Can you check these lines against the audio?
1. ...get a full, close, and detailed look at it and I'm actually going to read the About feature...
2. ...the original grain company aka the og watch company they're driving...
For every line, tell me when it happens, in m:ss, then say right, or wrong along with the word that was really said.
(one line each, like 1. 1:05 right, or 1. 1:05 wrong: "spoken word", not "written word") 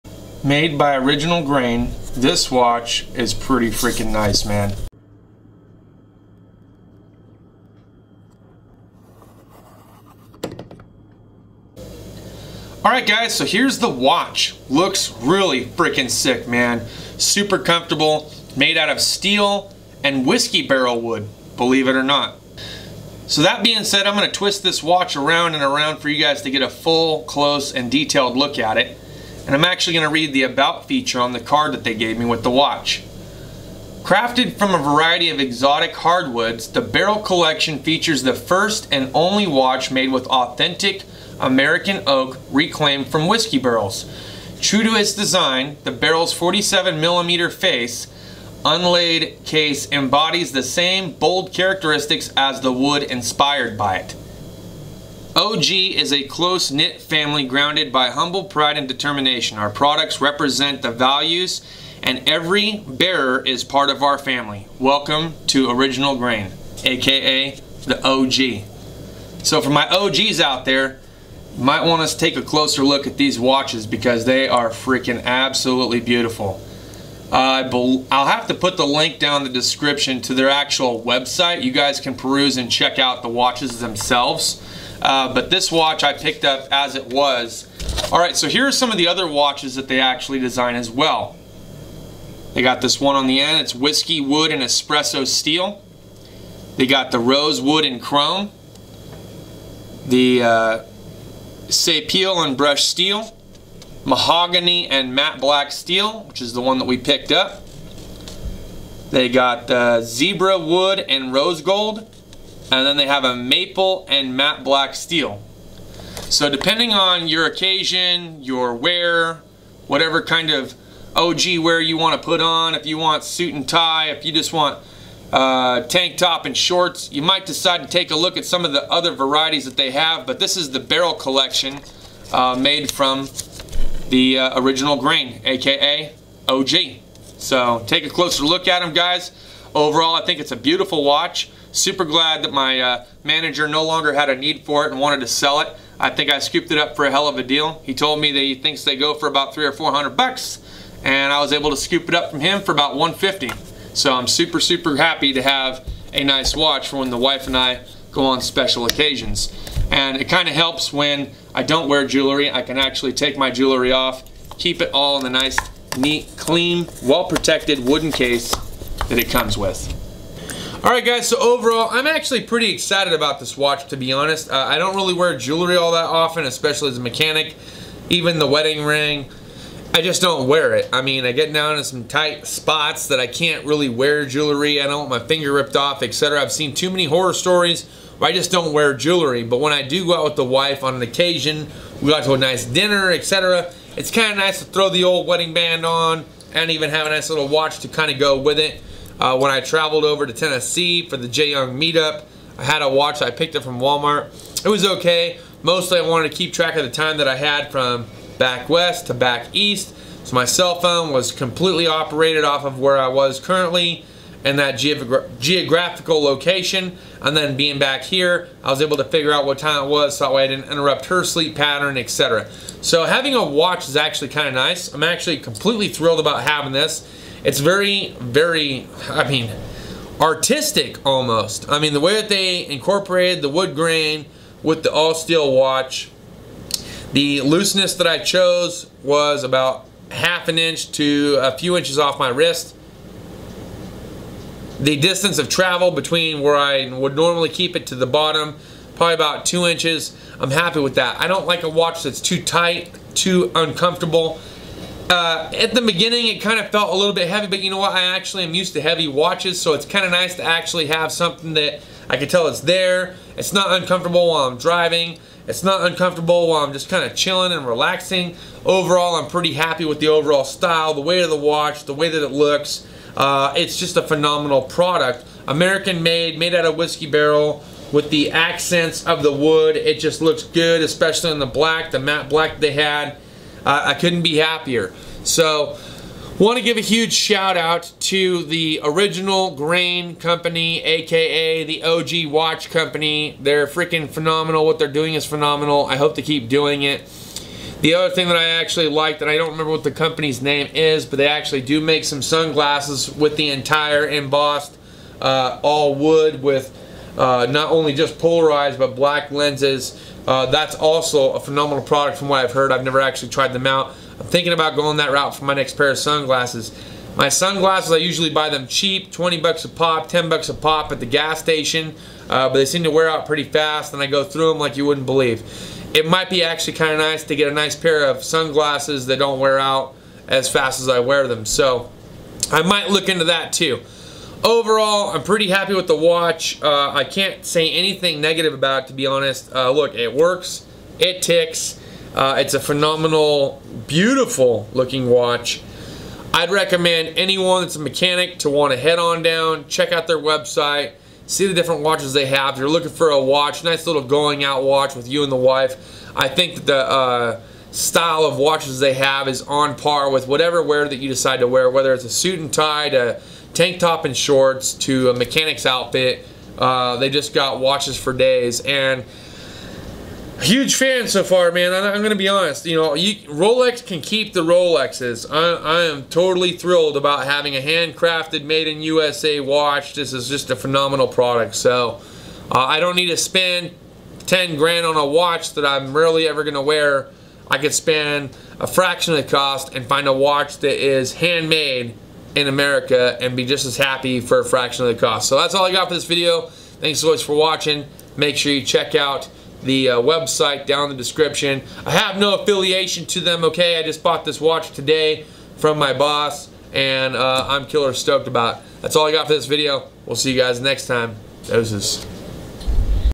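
1. 0:26 right
2. 4:48 wrong: "freaking", not "driving".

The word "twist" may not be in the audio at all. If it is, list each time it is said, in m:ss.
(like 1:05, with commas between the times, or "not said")
0:24.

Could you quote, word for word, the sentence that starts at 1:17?
Uh, I'll have to put the link down the description to their actual website.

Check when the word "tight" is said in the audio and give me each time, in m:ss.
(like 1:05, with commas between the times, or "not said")
3:02, 4:12.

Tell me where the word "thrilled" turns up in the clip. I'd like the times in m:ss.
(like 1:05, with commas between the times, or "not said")
3:45, 6:16.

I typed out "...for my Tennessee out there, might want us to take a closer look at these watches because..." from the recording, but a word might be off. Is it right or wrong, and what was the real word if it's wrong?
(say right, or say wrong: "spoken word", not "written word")
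wrong: "OGs", not "Tennessee".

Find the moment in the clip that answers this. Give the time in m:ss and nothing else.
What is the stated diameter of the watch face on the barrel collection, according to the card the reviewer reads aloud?
0:46.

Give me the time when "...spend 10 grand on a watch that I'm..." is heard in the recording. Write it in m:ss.
6:23.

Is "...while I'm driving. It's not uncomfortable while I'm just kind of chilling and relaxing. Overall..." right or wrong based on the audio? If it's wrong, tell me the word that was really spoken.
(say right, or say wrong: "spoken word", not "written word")
right.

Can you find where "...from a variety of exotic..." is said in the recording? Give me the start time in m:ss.
0:34.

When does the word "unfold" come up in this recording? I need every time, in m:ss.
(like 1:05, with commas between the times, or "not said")
not said.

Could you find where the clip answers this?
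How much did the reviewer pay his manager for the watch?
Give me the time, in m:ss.
2:32.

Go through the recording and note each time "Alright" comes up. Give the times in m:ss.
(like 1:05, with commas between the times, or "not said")
0:12, 2:50.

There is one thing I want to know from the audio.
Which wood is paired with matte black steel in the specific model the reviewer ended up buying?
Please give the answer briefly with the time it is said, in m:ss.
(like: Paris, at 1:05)
Mahogany, at 1:44.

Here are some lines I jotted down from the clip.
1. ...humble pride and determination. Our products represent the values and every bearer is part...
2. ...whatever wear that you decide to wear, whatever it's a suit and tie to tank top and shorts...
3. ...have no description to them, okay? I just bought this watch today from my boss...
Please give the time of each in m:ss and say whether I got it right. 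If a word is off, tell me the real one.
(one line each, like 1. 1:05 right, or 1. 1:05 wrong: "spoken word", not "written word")
1. 0:58 right
2. 6:00 wrong: "whether", not "whatever"
3. 6:41 wrong: "affiliation", not "description".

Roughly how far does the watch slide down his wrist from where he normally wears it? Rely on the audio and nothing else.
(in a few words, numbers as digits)
about two inches.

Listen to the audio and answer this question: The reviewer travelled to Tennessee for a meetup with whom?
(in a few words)
Jay Young.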